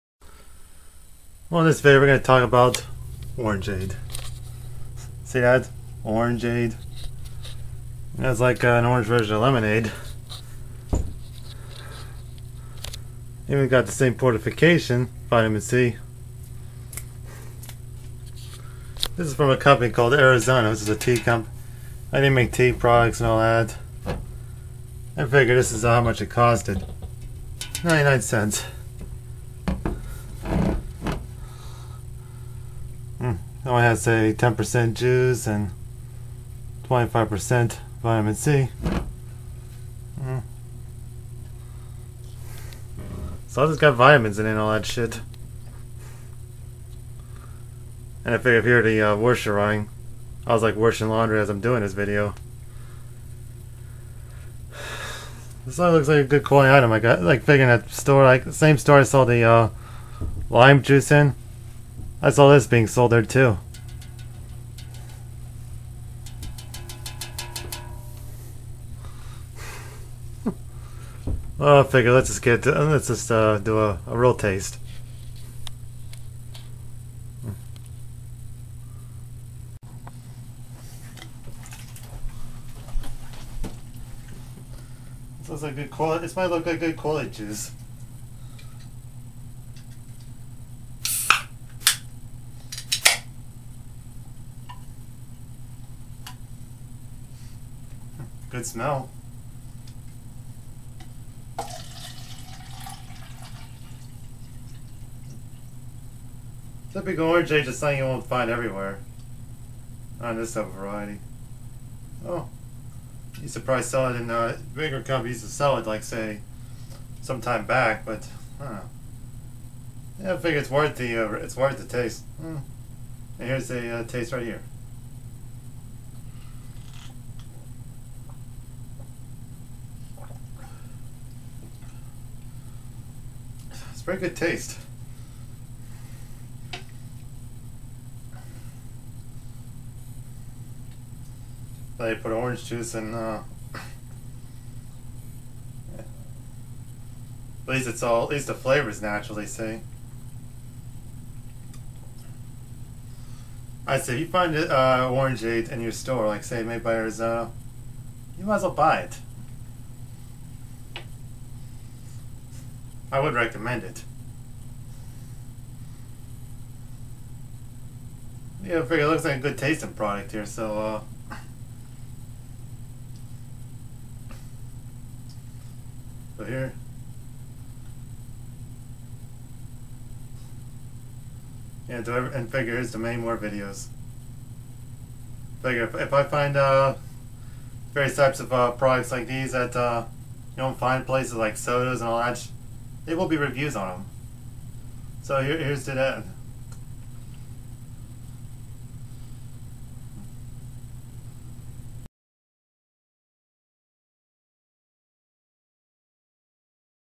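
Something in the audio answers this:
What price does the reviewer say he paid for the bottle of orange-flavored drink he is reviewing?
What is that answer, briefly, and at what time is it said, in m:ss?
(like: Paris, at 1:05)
99 cents, at 0:27.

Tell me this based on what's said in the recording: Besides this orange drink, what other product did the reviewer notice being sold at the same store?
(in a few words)
lime juice.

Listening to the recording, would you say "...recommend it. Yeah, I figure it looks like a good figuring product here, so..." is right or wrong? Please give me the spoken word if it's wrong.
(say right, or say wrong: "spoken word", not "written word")
wrong: "tasting", not "figuring".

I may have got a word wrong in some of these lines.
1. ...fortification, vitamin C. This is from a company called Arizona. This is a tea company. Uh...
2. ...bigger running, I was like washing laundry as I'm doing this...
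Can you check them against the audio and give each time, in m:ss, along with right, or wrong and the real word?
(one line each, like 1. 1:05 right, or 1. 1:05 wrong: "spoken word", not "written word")
1. 0:14 right
2. 0:49 wrong: "washer", not "bigger".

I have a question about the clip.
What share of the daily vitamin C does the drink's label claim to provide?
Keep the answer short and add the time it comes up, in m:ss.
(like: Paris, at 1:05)
25%, at 0:36.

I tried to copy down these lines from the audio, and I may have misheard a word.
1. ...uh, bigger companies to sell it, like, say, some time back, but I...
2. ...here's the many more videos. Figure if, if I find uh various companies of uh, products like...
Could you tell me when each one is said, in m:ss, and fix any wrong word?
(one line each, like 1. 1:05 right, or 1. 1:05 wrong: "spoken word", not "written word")
1. 1:54 right
2. 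3:02 wrong: "types", not "companies".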